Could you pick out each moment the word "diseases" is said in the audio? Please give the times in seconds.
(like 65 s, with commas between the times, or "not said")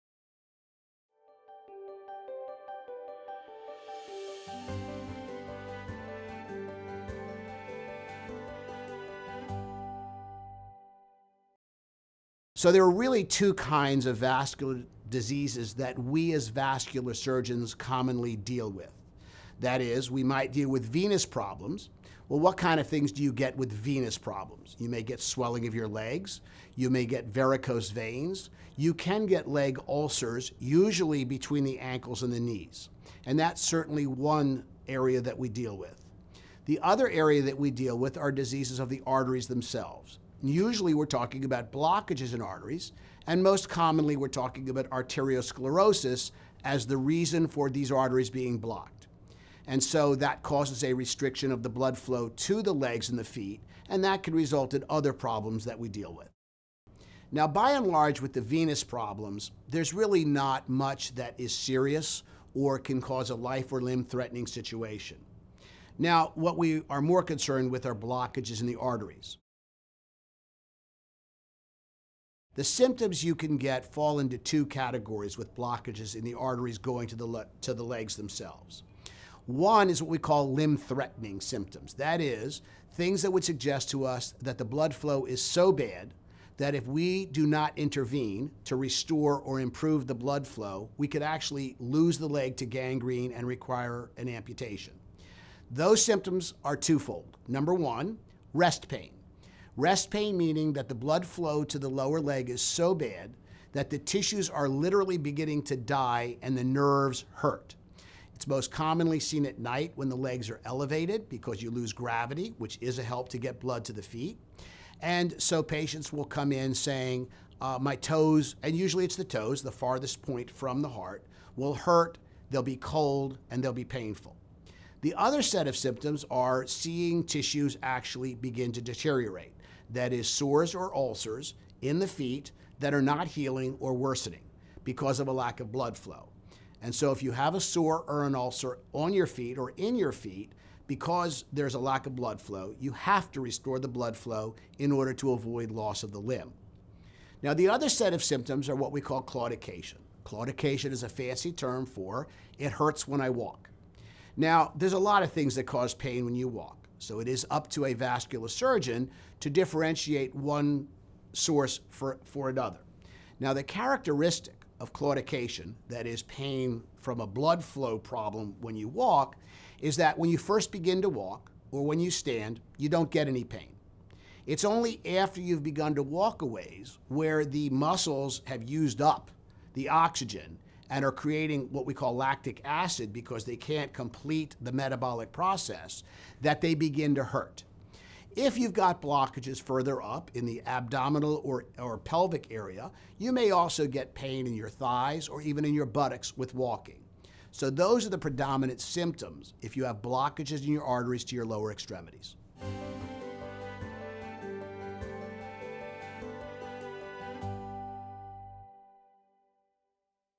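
15 s, 38 s.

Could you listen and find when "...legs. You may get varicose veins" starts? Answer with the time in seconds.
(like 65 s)
25 s.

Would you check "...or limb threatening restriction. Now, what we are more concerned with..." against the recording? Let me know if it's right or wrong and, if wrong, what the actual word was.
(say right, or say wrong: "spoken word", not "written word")
wrong: "situation", not "restriction".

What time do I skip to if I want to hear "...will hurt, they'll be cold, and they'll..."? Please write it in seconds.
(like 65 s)
121 s.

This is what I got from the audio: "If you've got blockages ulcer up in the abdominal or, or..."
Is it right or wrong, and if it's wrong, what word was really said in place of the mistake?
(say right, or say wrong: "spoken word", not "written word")
wrong: "further", not "ulcer".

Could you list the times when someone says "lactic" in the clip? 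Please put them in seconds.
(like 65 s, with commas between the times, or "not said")
182 s.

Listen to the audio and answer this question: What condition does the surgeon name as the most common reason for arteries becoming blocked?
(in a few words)
Arteriosclerosis.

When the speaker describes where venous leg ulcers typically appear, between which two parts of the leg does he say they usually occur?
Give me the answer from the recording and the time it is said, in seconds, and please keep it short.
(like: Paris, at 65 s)
Between the ankles and the knees, at 31 s.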